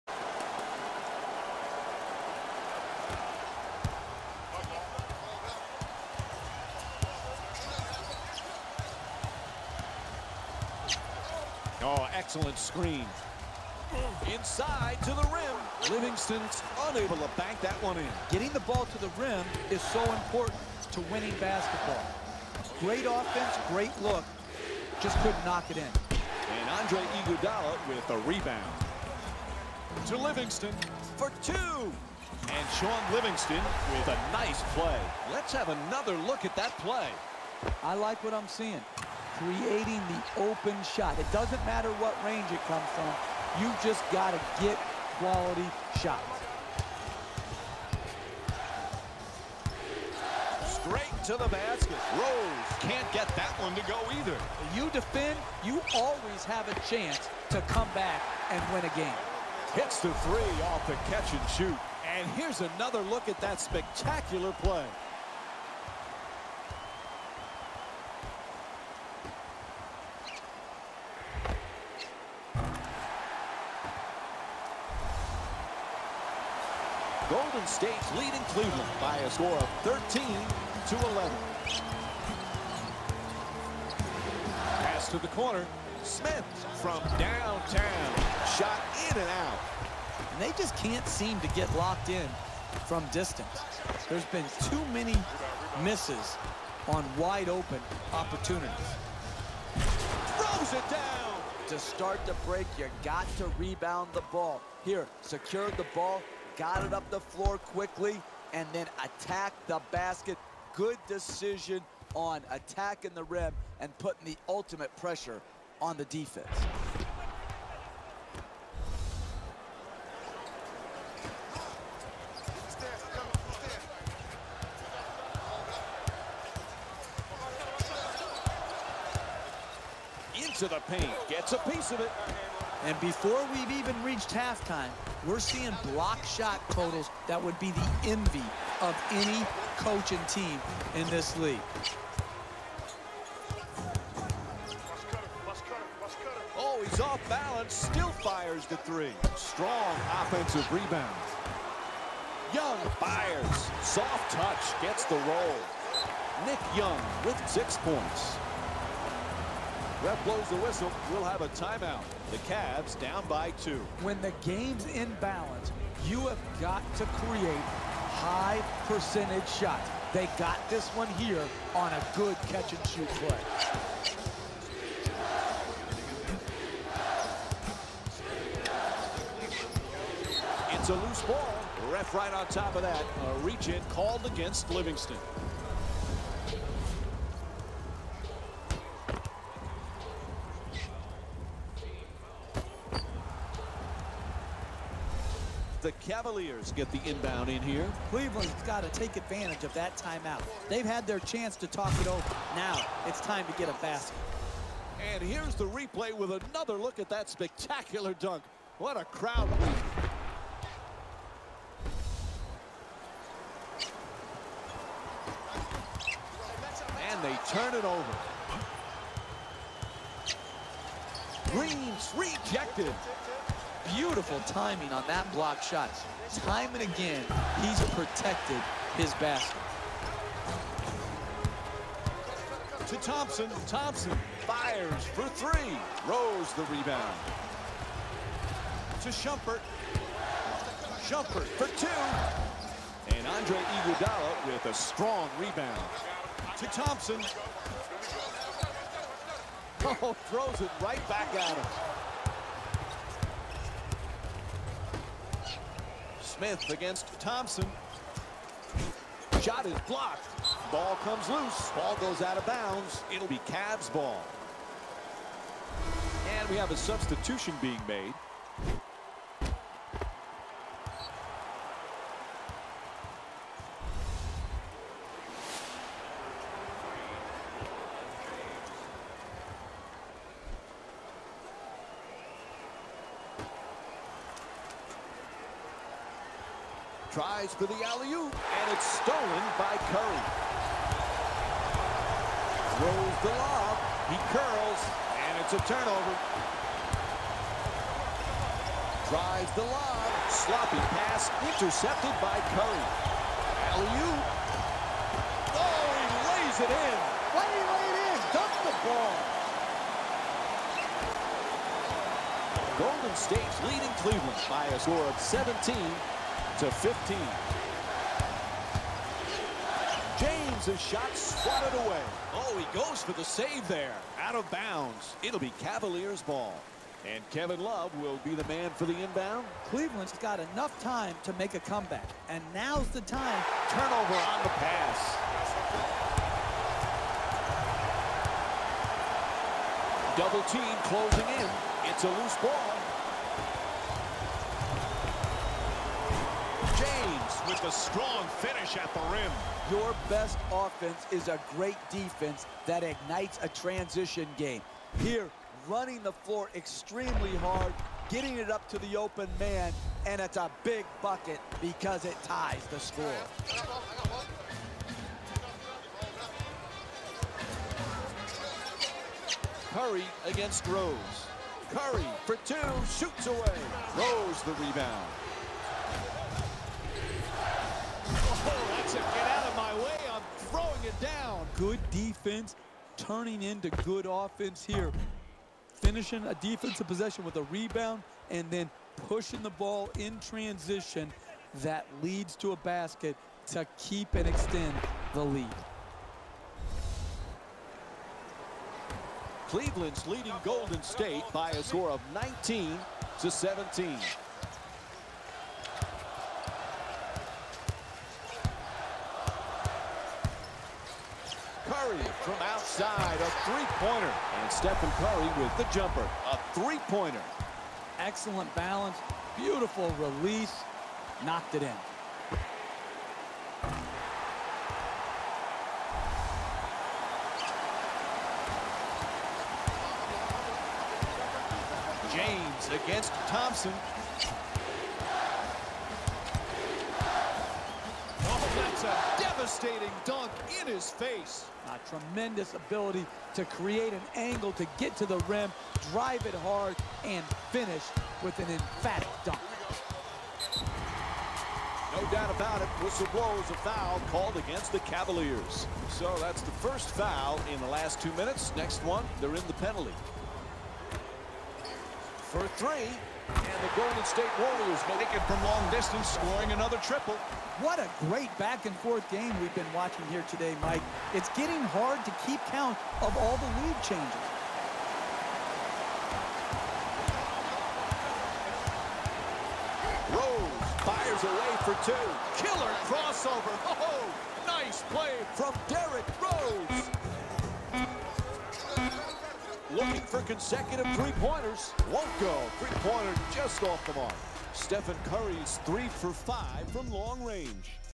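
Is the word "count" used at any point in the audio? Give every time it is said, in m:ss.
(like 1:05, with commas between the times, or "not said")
7:52.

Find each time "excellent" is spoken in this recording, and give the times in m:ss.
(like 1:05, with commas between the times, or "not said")
0:12, 6:57.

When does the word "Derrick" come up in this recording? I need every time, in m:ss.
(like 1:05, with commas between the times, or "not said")
8:05.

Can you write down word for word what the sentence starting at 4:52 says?
Throws the lob, he curls, and it's a turnover.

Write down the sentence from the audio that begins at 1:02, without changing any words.
And here's another look at that spectacular play.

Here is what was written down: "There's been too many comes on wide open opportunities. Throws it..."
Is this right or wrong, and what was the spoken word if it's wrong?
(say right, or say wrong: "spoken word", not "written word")
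wrong: "misses", not "comes".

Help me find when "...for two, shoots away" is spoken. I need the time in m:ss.
6:12.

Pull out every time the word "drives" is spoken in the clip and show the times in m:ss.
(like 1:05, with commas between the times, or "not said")
4:59, 7:25.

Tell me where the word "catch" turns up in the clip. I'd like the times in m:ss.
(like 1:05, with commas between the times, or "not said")
1:01, 2:52.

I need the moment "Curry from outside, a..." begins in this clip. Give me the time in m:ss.
6:51.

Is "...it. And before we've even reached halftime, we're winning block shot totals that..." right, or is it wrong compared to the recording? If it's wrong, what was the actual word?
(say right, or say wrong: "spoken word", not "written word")
wrong: "seeing", not "winning".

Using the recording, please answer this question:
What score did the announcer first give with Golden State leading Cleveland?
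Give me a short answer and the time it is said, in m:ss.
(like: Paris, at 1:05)
13 to 11, at 1:19.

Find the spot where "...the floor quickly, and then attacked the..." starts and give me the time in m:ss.
1:47.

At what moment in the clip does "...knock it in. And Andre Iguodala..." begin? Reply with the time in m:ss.
0:25.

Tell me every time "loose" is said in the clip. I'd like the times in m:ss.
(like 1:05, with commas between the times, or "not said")
3:00, 4:21, 5:42.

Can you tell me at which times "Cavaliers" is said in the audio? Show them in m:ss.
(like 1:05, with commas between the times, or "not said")
3:15, 5:25, 7:34.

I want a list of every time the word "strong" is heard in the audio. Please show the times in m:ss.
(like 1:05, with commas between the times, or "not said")
2:29, 4:04, 5:47.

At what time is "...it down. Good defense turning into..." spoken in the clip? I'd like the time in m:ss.
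6:20.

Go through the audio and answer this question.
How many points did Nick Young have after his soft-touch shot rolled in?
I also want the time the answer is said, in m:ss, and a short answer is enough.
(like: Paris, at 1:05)
6, at 2:37.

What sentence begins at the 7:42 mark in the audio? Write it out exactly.
For three, and the Golden State Warriors make it from long distance, scoring another triple.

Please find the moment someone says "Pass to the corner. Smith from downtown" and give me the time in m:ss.
1:24.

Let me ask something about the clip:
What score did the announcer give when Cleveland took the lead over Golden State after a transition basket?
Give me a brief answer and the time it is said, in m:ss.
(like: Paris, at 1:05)
19 to 17, at 6:42.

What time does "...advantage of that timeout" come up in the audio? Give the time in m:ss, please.
3:19.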